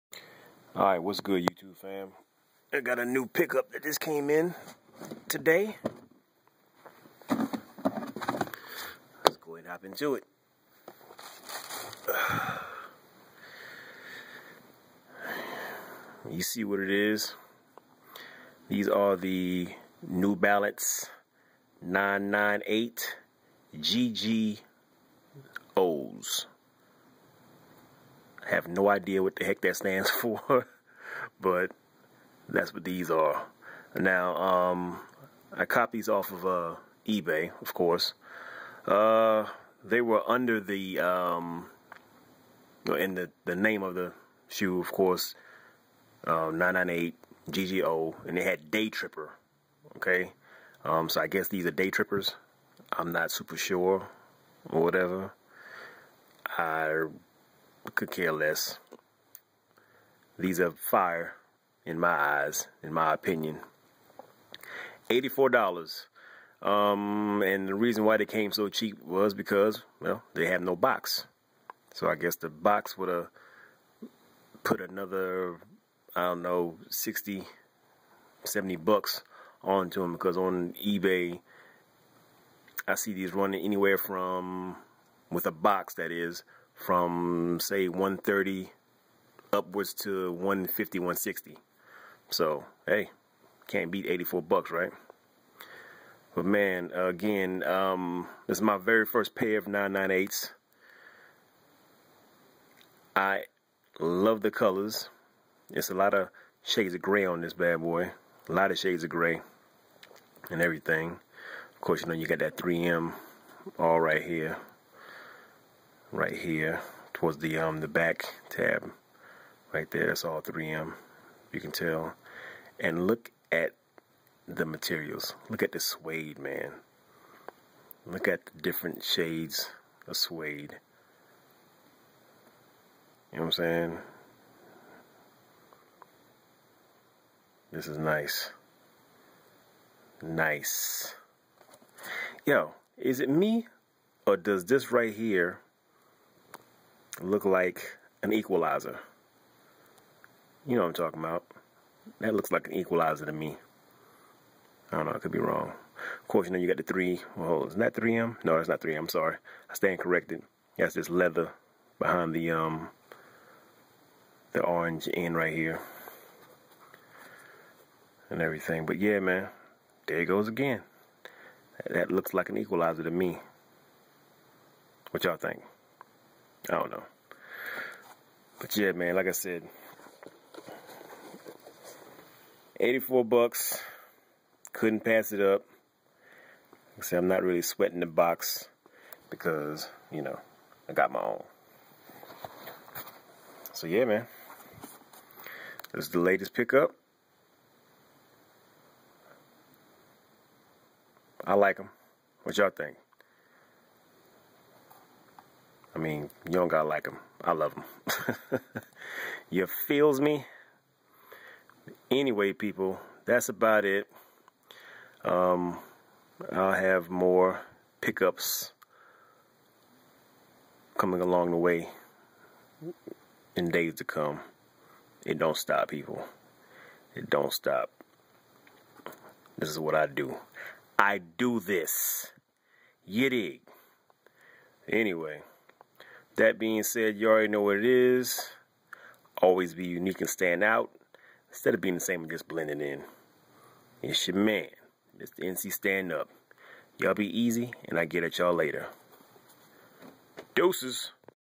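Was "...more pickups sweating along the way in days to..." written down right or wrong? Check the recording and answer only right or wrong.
wrong.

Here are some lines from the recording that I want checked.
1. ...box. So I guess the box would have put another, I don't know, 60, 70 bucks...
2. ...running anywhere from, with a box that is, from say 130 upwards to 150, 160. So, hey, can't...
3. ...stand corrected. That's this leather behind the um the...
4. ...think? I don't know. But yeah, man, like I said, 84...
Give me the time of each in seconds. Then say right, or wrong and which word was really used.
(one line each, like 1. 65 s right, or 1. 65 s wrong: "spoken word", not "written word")
1. 70 s right
2. 83 s right
3. 159 s right
4. 175 s right.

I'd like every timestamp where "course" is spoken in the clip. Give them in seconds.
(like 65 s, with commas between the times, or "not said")
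37 s, 44 s, 111 s, 156 s.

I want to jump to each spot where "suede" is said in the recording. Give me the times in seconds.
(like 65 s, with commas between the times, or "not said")
125 s, 130 s.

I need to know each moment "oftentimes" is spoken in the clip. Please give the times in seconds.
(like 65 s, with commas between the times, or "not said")
not said.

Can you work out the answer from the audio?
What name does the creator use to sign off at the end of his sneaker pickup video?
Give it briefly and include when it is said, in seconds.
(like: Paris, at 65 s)
Mr. NC Stand Up, at 245 s.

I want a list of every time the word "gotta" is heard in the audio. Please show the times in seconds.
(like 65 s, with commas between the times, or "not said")
206 s.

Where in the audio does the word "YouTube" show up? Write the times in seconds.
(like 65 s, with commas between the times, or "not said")
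1 s.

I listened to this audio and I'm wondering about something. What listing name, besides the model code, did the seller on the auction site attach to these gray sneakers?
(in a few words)
Day Tripper.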